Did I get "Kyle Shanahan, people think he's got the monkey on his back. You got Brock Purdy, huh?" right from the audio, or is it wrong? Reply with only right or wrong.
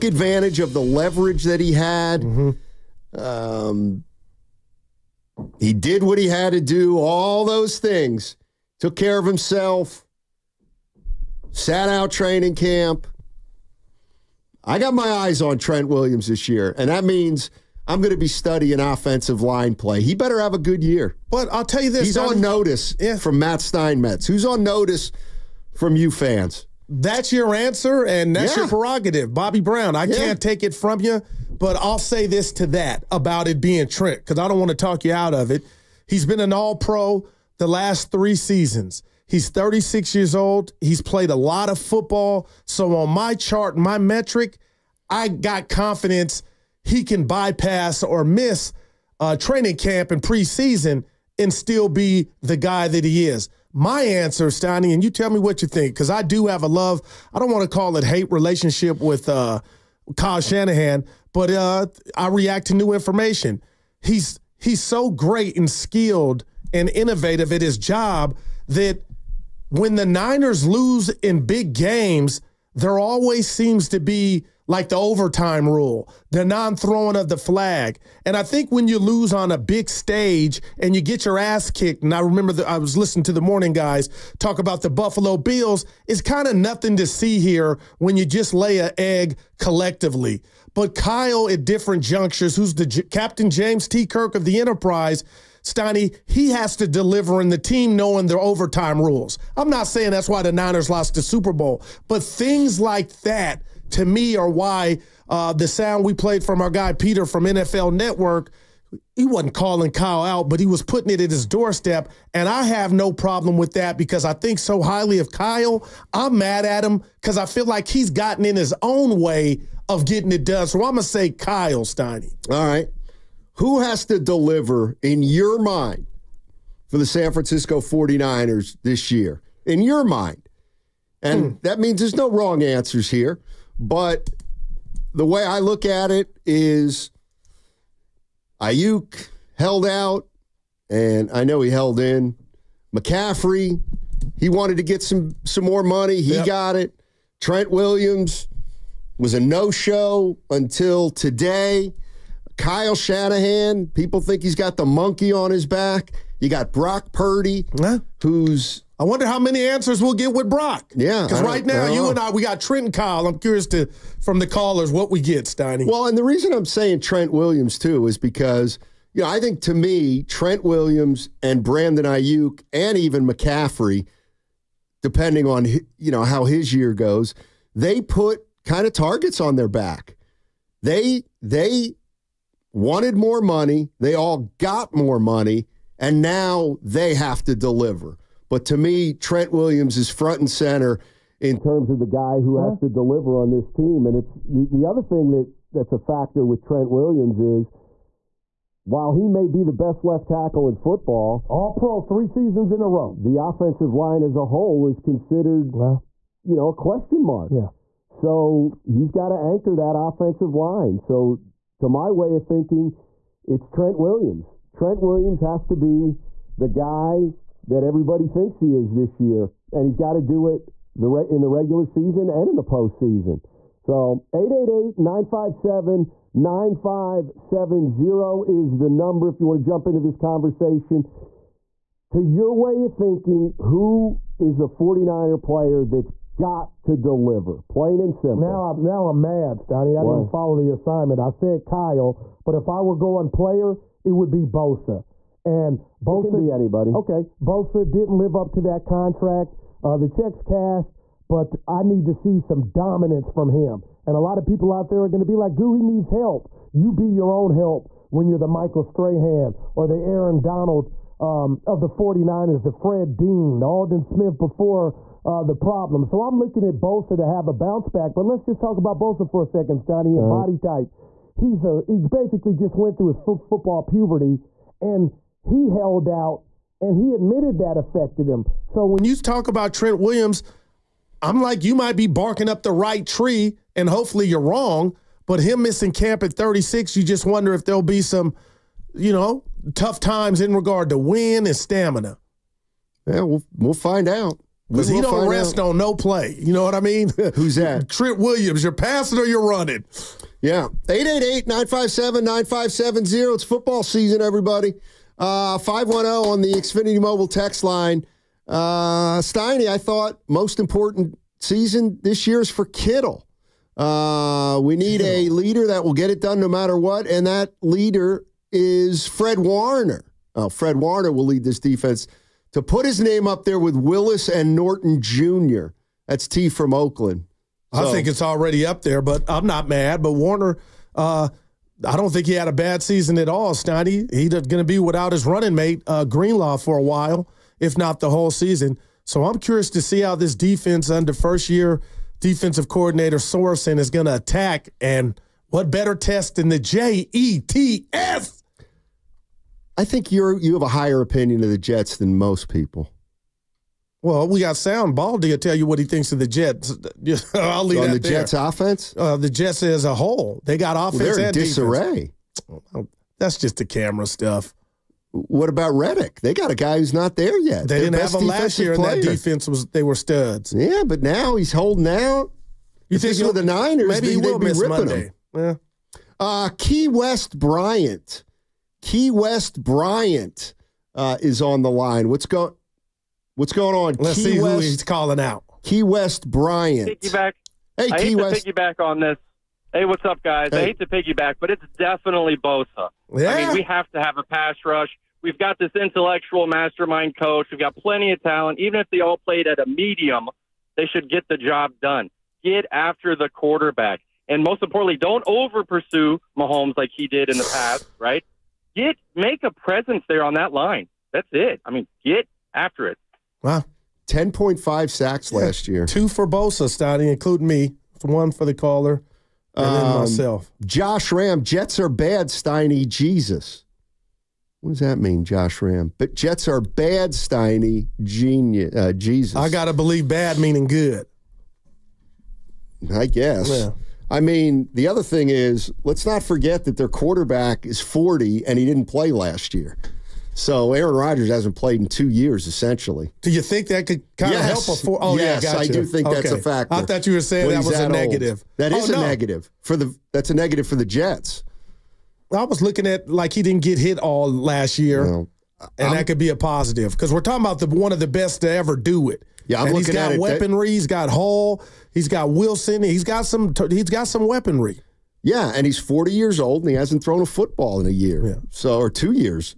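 right.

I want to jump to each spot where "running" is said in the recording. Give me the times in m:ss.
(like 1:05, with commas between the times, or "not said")
4:59, 5:35.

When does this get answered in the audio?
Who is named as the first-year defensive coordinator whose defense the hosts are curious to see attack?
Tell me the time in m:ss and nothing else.
5:43.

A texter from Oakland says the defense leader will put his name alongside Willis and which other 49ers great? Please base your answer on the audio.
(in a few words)
Norton Jr.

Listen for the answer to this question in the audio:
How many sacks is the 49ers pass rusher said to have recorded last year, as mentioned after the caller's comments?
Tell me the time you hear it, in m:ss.
6:54.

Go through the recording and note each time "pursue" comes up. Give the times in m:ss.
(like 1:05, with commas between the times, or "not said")
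6:45.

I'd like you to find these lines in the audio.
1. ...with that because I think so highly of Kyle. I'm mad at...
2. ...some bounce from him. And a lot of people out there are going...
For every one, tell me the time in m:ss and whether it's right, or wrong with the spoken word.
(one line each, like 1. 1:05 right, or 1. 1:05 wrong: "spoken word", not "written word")
1. 1:53 right
2. 4:12 wrong: "dominance", not "bounce".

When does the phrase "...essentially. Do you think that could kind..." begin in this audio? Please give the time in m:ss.
7:22.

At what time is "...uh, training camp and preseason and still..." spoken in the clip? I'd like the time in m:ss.
0:49.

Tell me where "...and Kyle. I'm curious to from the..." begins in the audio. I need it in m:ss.
2:42.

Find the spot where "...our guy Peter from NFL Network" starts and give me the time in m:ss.
1:46.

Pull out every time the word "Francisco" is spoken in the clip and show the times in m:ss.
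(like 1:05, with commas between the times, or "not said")
2:07.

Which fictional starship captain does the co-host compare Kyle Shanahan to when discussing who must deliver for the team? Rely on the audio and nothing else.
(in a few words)
Captain James T. Kirk.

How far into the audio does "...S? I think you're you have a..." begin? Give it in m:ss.
5:47.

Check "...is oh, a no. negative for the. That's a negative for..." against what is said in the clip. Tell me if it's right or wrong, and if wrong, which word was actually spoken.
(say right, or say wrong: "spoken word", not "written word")
right.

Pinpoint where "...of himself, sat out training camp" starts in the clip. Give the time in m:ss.
0:09.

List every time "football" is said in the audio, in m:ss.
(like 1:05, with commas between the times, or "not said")
0:41, 3:20, 4:33, 5:03, 7:47.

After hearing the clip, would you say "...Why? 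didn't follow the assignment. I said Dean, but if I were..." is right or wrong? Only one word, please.
wrong.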